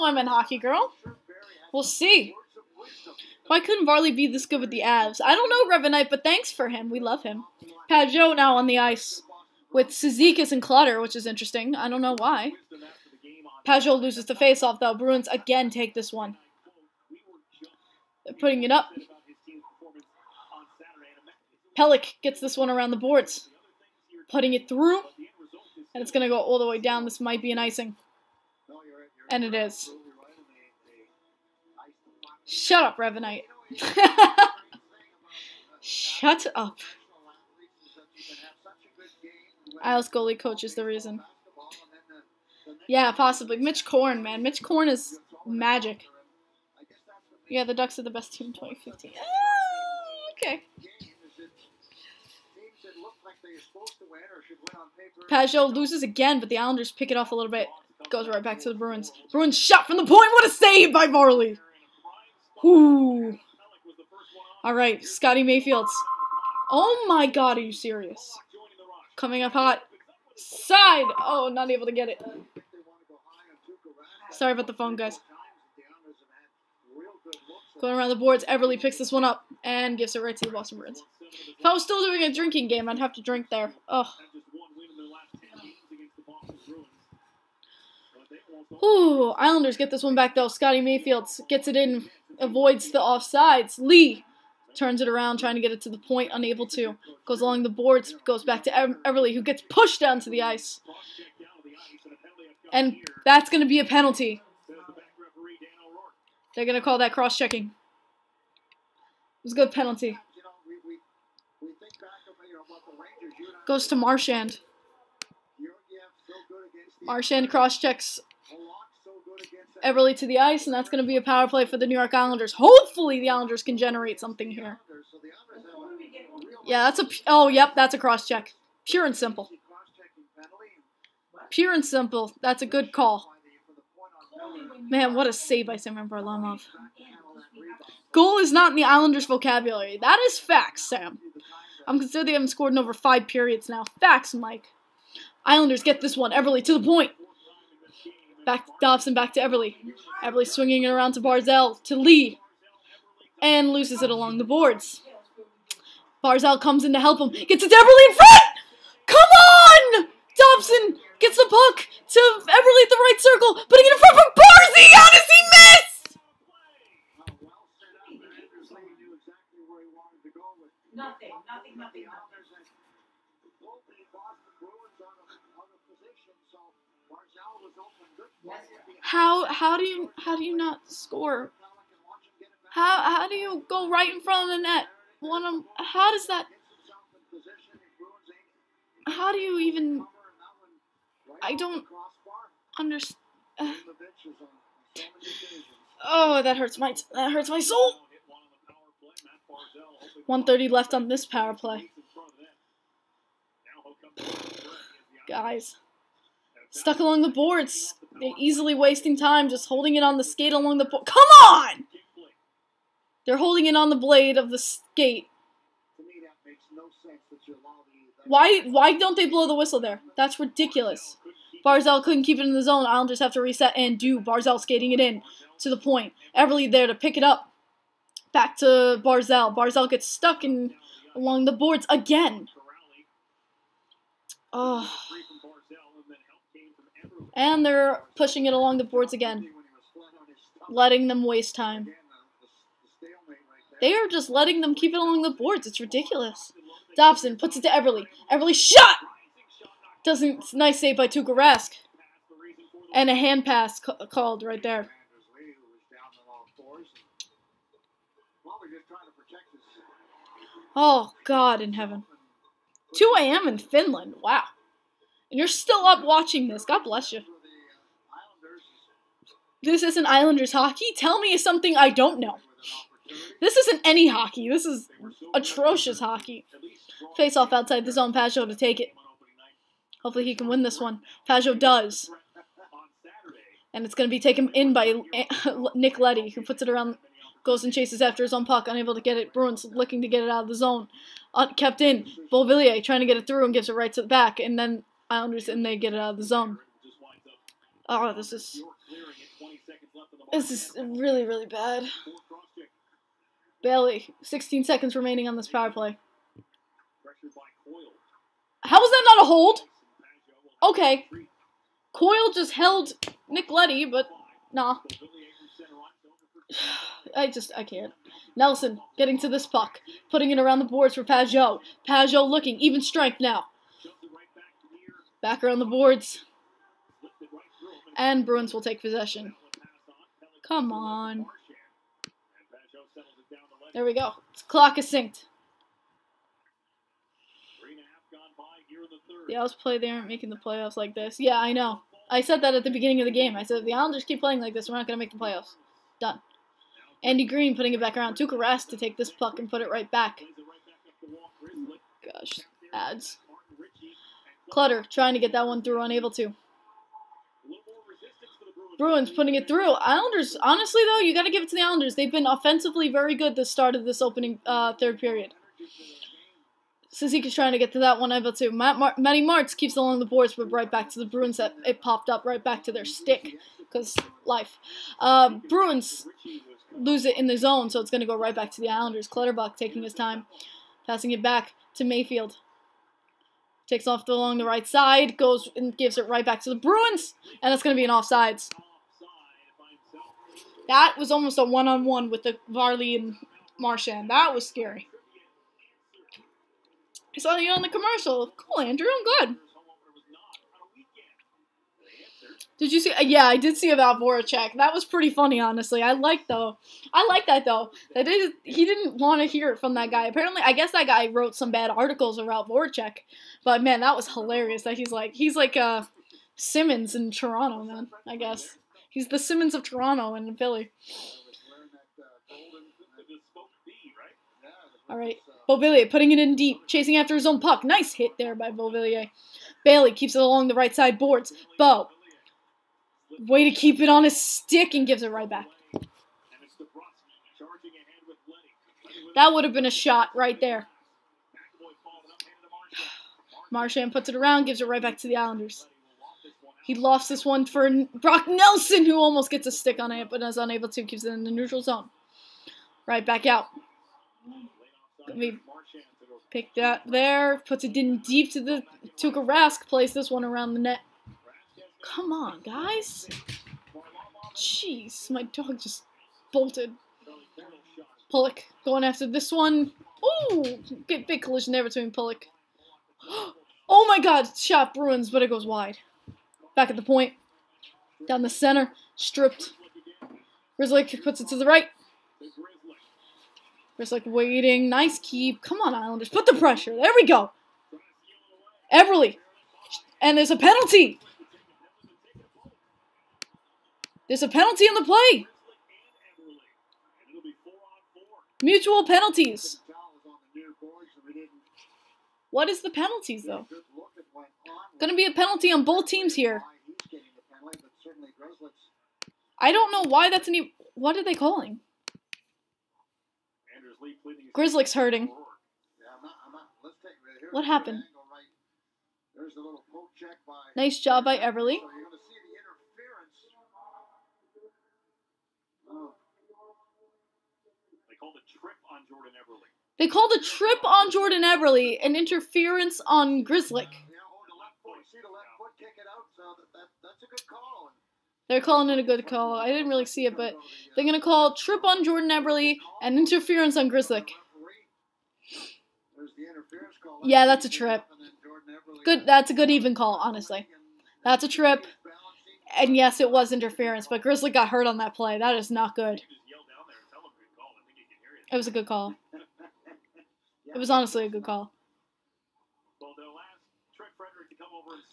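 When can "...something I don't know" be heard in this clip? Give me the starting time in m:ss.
4:31.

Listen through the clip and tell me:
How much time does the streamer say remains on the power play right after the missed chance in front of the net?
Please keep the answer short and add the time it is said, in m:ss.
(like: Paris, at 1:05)
1:30, at 3:20.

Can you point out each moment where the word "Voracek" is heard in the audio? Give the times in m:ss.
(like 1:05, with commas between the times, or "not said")
6:44, 6:52.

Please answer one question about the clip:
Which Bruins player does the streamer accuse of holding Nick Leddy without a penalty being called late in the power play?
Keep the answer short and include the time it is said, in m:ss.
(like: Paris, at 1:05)
Coyle, at 5:11.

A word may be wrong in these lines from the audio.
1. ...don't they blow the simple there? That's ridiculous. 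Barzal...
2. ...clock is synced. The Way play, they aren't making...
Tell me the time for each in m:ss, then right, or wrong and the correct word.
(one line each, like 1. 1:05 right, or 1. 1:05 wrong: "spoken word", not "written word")
1. 3:38 wrong: "whistle", not "simple"
2. 5:34 wrong: "Owls", not "Way".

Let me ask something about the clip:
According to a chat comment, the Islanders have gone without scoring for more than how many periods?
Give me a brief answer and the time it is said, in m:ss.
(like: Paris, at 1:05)
5, at 2:22.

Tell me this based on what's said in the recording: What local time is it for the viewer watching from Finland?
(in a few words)
2 a.m.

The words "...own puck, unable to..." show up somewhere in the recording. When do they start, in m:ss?
4:48.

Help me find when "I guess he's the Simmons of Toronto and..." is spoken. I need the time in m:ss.
6:58.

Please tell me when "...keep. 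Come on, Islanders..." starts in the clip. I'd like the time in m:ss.
8:04.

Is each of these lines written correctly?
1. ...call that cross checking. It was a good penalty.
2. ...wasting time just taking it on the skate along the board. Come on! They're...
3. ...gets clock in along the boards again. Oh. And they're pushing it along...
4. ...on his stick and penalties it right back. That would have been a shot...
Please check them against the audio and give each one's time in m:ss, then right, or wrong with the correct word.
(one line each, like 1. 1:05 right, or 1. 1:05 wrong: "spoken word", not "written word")
1. 1:46 right
2. 3:28 wrong: "holding", not "taking"
3. 3:49 wrong: "stuck", not "clock"
4. 7:13 wrong: "gives", not "penalties".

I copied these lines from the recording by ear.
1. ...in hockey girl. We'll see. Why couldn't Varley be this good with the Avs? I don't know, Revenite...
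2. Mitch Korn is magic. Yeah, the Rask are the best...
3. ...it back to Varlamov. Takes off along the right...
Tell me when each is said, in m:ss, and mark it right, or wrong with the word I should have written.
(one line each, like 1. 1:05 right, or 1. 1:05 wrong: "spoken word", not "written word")
1. 0:00 right
2. 0:44 wrong: "Ducks", not "Rask"
3. 6:21 wrong: "Mayfield", not "Varlamov".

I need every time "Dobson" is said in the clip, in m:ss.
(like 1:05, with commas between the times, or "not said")
2:28, 2:40, 4:06.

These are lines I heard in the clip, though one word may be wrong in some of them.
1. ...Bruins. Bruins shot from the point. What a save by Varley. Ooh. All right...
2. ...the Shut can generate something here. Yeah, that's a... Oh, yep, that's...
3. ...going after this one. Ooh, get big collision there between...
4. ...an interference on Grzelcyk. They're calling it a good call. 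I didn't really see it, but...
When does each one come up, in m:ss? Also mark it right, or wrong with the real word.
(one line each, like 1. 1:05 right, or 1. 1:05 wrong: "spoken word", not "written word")
1. 0:58 right
2. 2:03 wrong: "Islanders", not "Shut"
3. 7:48 right
4. 8:51 right.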